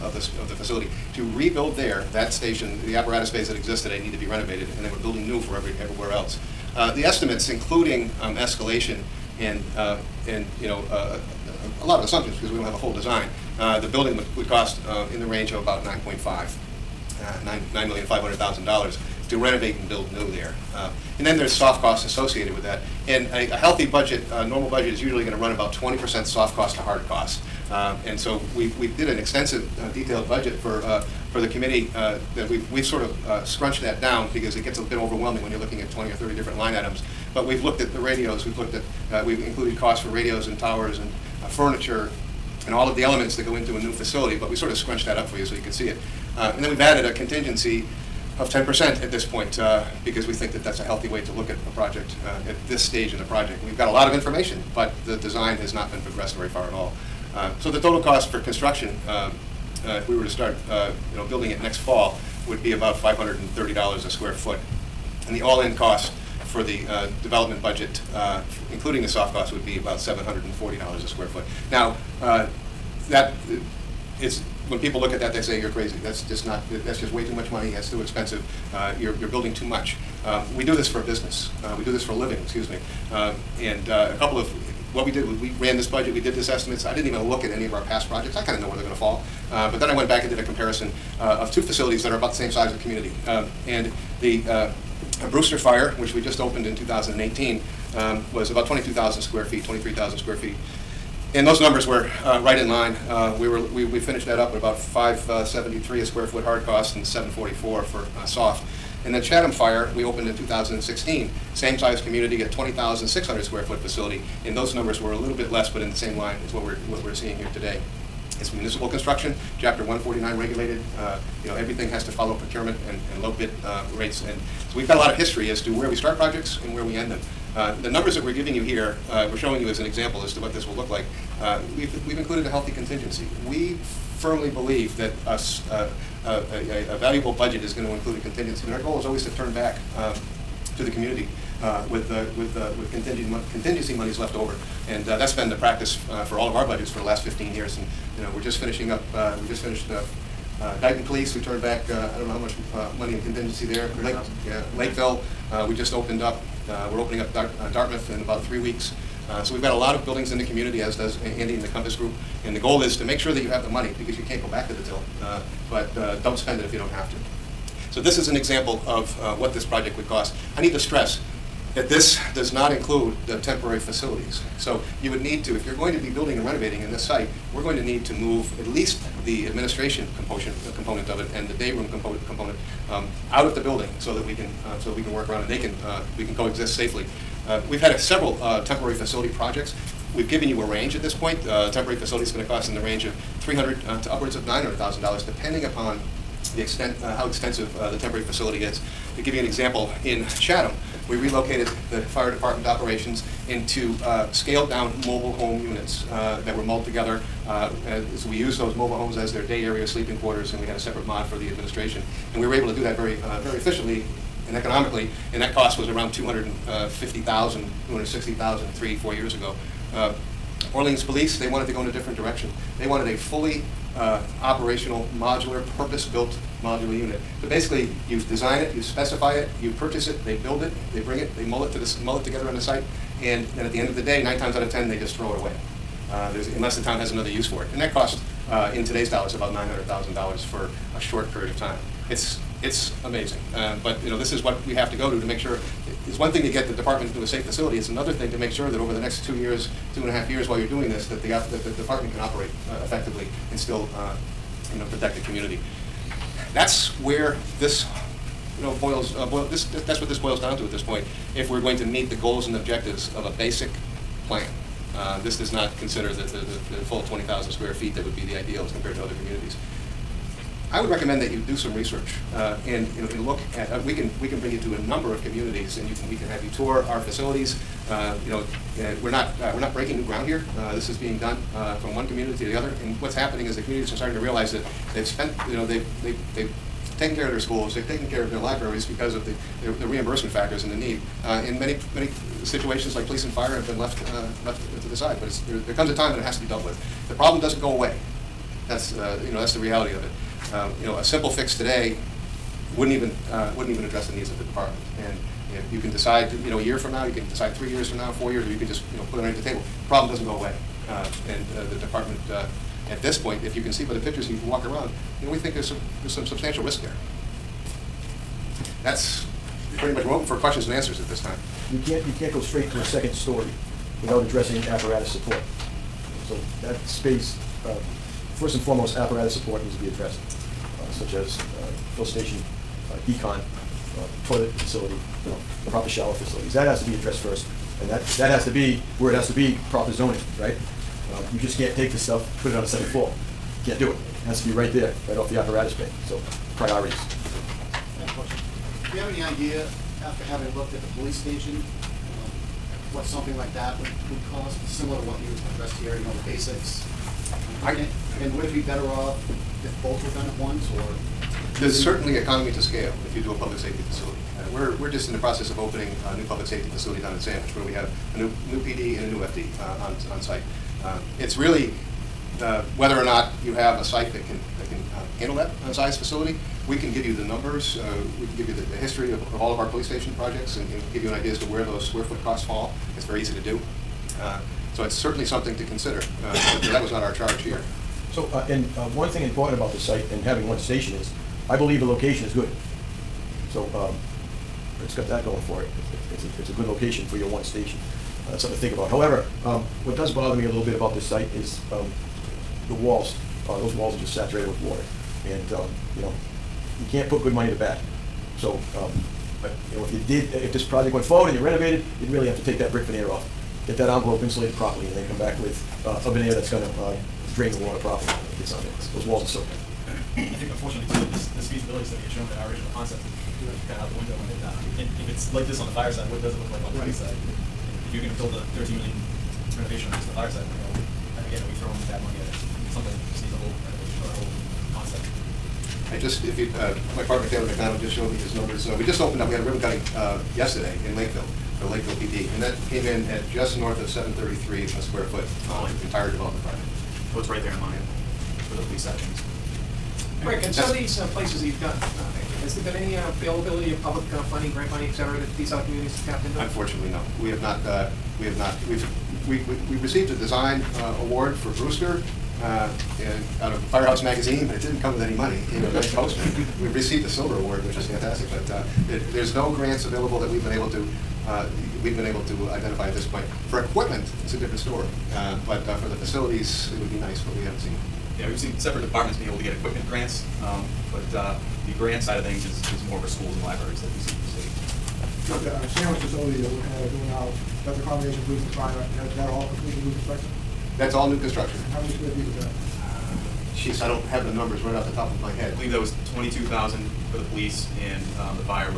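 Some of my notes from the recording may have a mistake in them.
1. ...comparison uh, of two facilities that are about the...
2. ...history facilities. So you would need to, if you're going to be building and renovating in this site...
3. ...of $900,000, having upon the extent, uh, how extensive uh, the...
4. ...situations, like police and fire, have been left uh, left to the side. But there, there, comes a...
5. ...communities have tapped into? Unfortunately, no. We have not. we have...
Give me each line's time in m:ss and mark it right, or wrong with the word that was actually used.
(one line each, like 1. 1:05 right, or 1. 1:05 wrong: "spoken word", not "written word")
1. 1:30 right
2. 2:53 wrong: "temporary", not "history"
3. 3:14 wrong: "depending", not "having"
4. 4:52 right
5. 7:35 right.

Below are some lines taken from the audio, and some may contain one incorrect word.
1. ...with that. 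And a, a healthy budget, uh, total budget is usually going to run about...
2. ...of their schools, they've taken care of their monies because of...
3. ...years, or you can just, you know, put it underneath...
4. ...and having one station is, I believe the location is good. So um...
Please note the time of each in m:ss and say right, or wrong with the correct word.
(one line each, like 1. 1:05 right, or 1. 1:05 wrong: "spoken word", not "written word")
1. 0:22 wrong: "normal", not "total"
2. 4:47 wrong: "libraries", not "monies"
3. 5:08 right
4. 6:30 right.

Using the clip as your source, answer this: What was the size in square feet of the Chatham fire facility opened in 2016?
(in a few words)
20,600.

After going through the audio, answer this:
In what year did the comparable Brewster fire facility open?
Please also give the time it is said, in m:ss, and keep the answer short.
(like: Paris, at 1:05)
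2018, at 1:36.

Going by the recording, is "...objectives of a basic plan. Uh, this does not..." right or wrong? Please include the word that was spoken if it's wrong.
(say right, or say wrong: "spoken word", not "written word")
right.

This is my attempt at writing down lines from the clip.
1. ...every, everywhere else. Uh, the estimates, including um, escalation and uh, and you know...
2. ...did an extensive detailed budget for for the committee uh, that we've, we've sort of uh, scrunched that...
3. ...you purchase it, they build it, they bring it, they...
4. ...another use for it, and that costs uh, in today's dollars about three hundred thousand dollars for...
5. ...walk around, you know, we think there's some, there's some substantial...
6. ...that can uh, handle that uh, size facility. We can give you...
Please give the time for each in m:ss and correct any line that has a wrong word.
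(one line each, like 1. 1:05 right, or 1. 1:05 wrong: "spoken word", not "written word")
1. 0:05 right
2. 0:28 right
3. 3:49 right
4. 3:57 wrong: "nine", not "three"
5. 5:14 right
6. 6:14 right.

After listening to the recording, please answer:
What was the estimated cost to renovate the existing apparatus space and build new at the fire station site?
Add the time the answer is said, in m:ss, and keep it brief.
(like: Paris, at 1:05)
$9,500,000, at 0:17.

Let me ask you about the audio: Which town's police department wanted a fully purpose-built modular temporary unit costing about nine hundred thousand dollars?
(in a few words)
Orleans.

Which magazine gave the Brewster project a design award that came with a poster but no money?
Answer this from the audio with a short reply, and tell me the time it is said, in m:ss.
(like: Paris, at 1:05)
Firehouse Magazine, at 7:43.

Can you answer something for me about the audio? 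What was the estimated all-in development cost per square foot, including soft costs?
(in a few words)
$740.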